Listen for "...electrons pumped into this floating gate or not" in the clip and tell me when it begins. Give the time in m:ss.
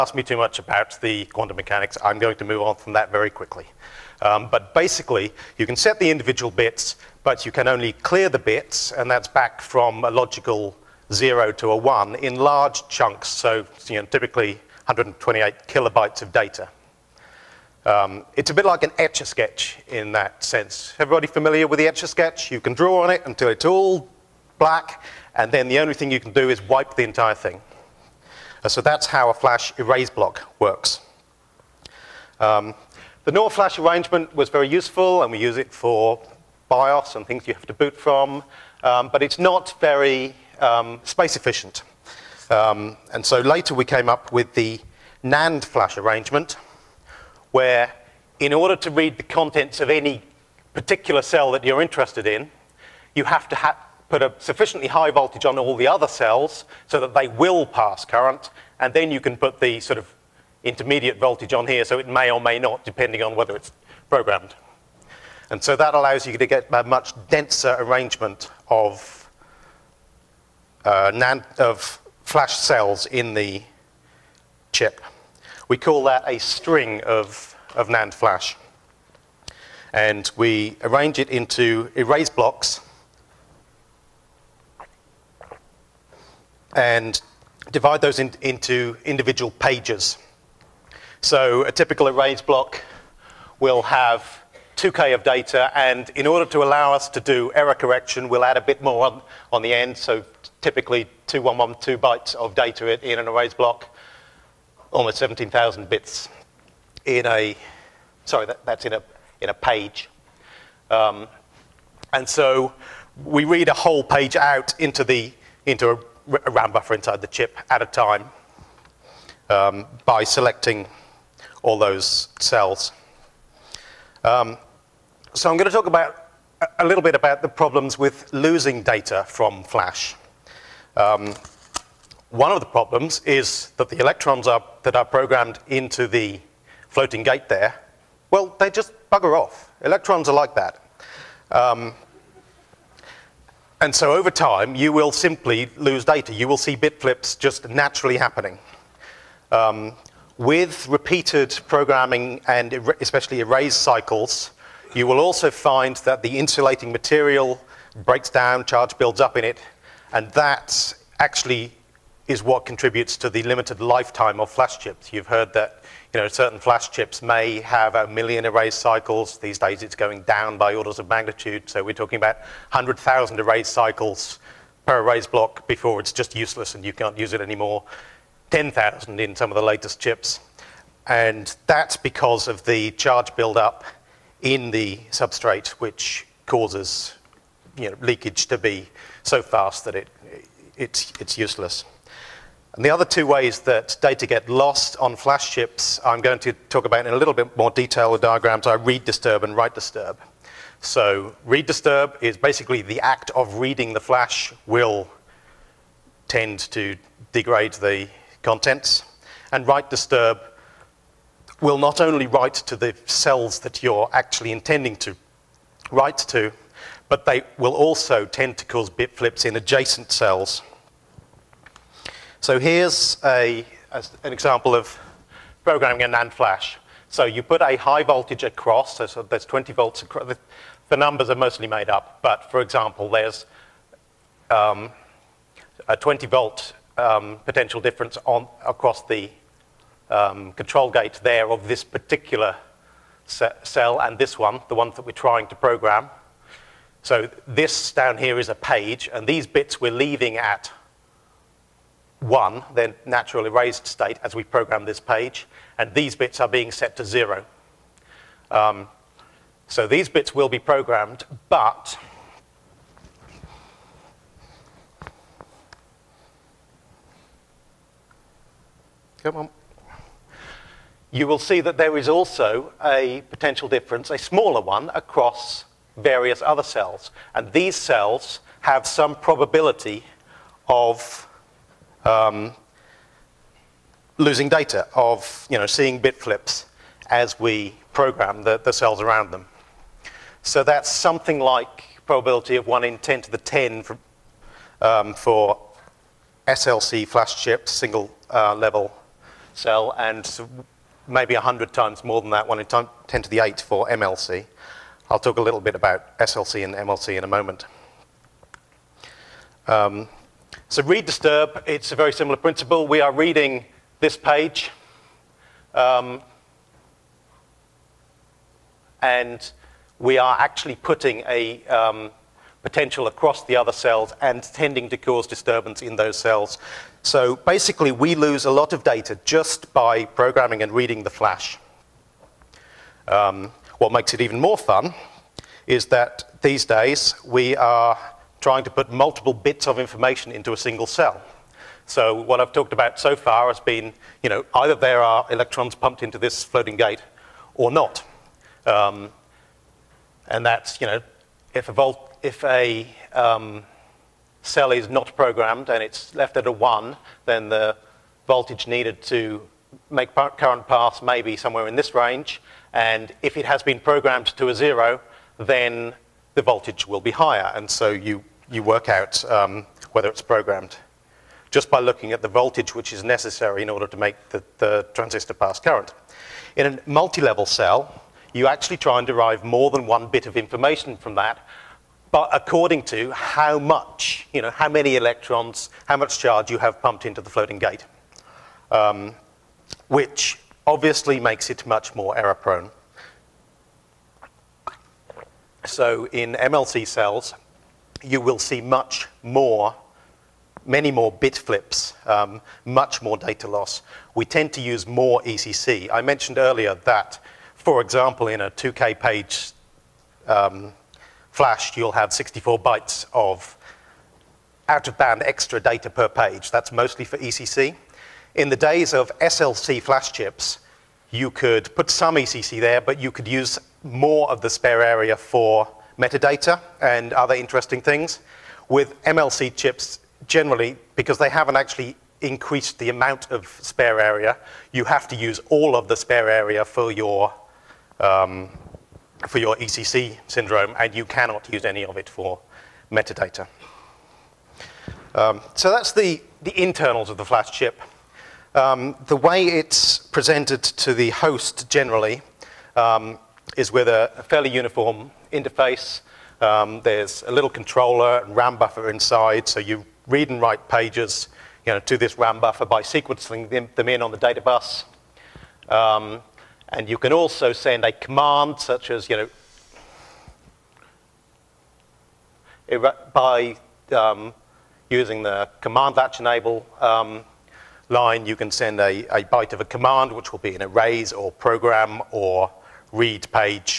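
5:45.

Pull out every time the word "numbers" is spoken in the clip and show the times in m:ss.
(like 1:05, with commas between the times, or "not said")
3:50.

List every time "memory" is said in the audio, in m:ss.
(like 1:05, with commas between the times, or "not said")
not said.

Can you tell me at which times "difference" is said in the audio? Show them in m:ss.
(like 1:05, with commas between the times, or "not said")
3:57, 4:33.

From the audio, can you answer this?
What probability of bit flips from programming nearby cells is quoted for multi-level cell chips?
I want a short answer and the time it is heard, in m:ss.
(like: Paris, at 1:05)
1 in 10 to the 8, at 5:02.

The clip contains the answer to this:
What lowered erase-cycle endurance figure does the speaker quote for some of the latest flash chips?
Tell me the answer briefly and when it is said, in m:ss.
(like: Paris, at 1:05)
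10,000, at 2:58.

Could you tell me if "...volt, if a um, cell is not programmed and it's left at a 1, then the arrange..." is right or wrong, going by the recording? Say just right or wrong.
wrong.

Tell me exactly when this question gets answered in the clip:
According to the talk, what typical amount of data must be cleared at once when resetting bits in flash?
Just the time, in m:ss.
0:14.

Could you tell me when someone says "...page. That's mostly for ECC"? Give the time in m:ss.
6:56.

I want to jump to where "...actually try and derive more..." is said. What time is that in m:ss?
6:18.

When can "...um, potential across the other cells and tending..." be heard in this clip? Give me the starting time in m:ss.
5:21.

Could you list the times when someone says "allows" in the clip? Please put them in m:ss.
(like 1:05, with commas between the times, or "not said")
1:05, 1:36.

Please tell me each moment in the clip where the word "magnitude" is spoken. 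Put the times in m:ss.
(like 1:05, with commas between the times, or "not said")
2:51.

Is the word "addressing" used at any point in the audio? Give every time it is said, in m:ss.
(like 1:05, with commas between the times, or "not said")
not said.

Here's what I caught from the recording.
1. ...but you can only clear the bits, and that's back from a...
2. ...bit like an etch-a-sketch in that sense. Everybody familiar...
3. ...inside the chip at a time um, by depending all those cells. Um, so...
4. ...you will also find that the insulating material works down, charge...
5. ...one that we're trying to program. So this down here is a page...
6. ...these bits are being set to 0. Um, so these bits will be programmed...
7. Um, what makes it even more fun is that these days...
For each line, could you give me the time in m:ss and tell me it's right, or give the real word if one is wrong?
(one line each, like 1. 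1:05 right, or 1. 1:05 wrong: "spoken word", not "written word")
1. 0:07 right
2. 0:18 right
3. 1:56 wrong: "selecting", not "depending"
4. 2:34 wrong: "breaks", not "works"
5. 4:04 right
6. 4:15 right
7. 5:33 right.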